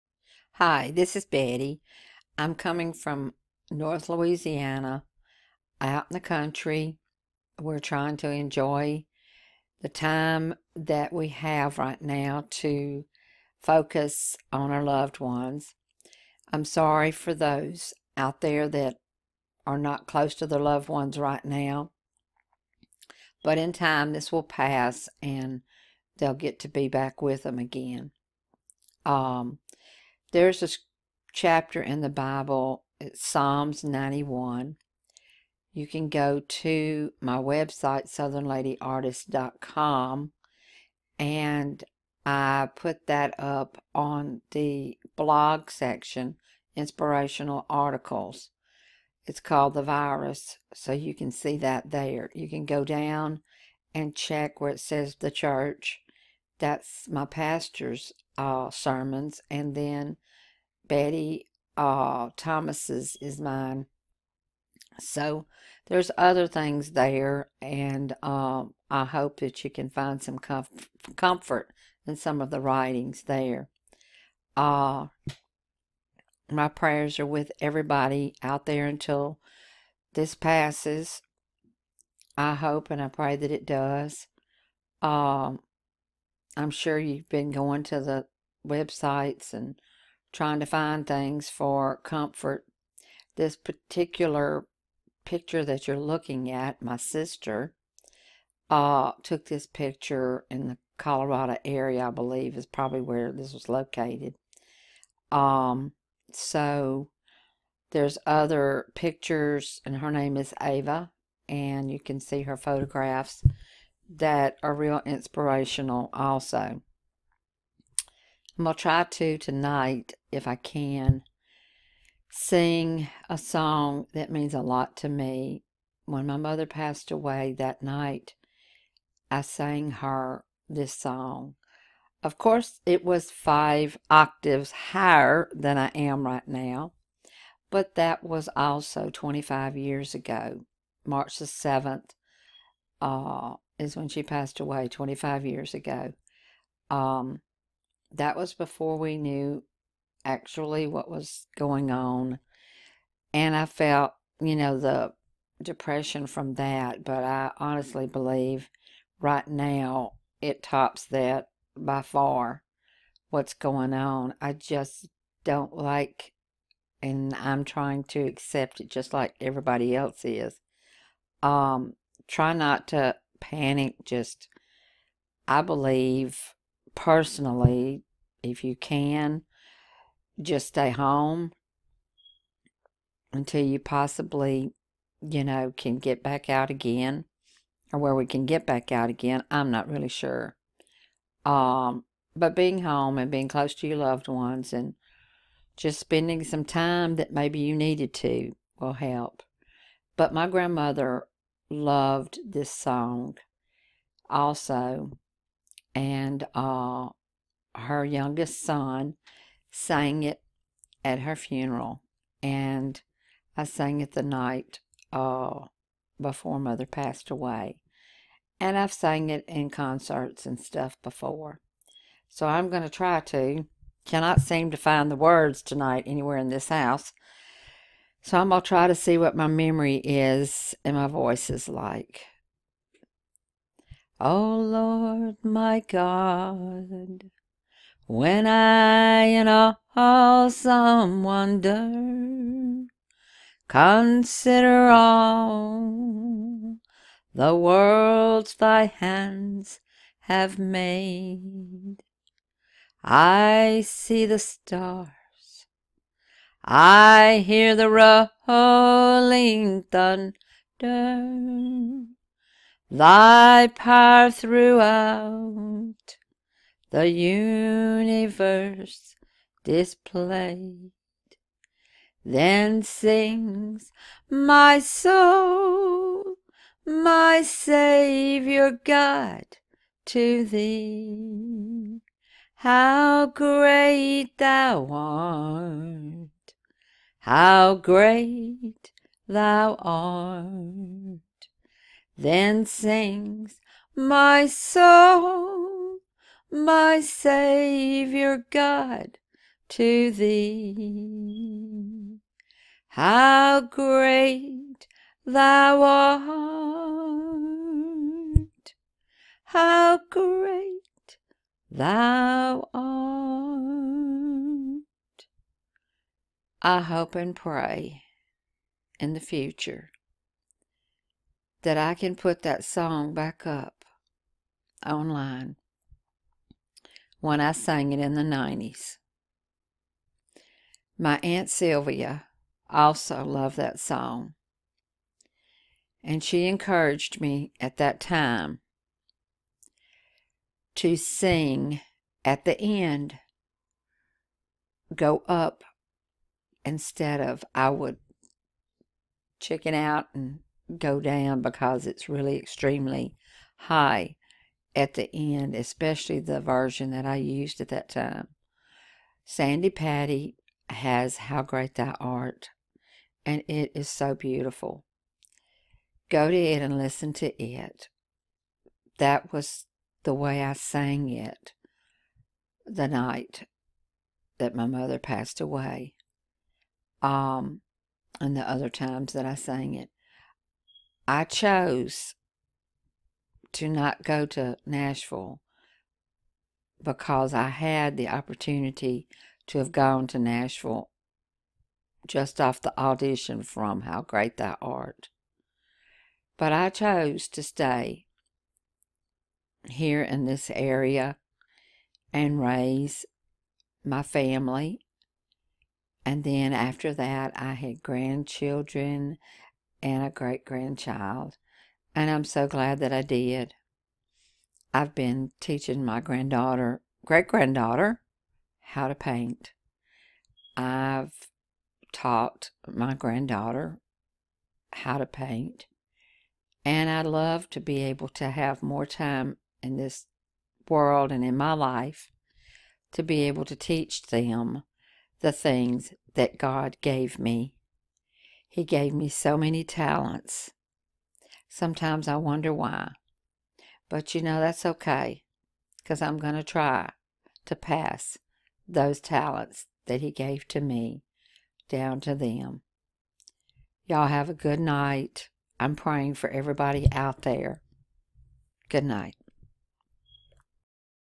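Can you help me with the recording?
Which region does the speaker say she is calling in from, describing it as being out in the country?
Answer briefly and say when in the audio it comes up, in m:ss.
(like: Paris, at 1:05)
North Louisiana, at 0:03.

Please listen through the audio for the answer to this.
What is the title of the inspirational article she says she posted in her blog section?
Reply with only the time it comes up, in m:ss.
0:49.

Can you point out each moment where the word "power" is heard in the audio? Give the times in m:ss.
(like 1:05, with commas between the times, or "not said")
4:23.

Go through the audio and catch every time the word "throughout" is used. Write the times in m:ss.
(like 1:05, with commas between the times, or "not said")
4:24.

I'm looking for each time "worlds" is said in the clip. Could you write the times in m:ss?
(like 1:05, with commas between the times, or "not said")
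4:07, 7:10.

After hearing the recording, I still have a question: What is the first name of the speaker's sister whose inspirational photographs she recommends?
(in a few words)
Ava.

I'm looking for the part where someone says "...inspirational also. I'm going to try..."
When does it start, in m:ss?
1:55.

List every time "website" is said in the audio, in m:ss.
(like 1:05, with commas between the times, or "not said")
0:37, 1:28.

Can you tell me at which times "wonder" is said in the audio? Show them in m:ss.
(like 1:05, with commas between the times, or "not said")
4:01, 7:22.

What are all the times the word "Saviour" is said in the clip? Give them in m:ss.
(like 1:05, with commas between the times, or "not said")
4:37, 4:56.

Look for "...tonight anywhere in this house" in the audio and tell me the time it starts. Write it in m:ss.
3:45.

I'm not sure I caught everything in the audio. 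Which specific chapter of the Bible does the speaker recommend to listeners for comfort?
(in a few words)
Psalm 91.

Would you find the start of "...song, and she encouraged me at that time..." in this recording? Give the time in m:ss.
5:33.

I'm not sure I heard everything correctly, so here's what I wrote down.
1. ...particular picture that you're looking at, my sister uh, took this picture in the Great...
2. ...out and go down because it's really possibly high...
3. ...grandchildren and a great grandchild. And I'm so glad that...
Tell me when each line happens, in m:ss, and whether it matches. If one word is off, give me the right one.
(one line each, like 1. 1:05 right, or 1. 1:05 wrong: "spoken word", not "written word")
1. 1:33 wrong: "Colorado", not "Great"
2. 5:49 wrong: "extremely", not "possibly"
3. 6:47 right.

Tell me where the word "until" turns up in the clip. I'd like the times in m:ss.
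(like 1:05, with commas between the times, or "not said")
1:18, 3:03.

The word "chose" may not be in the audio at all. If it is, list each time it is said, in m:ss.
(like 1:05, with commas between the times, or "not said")
6:21, 6:36.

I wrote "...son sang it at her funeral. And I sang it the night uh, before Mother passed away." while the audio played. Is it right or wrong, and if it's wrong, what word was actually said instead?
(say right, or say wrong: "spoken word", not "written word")
right.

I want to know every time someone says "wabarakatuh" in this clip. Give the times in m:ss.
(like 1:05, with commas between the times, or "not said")
not said.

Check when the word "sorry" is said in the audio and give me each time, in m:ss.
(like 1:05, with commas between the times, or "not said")
0:16.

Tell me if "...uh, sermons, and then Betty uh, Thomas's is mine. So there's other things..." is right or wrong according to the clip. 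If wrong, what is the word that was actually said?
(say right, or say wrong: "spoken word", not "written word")
right.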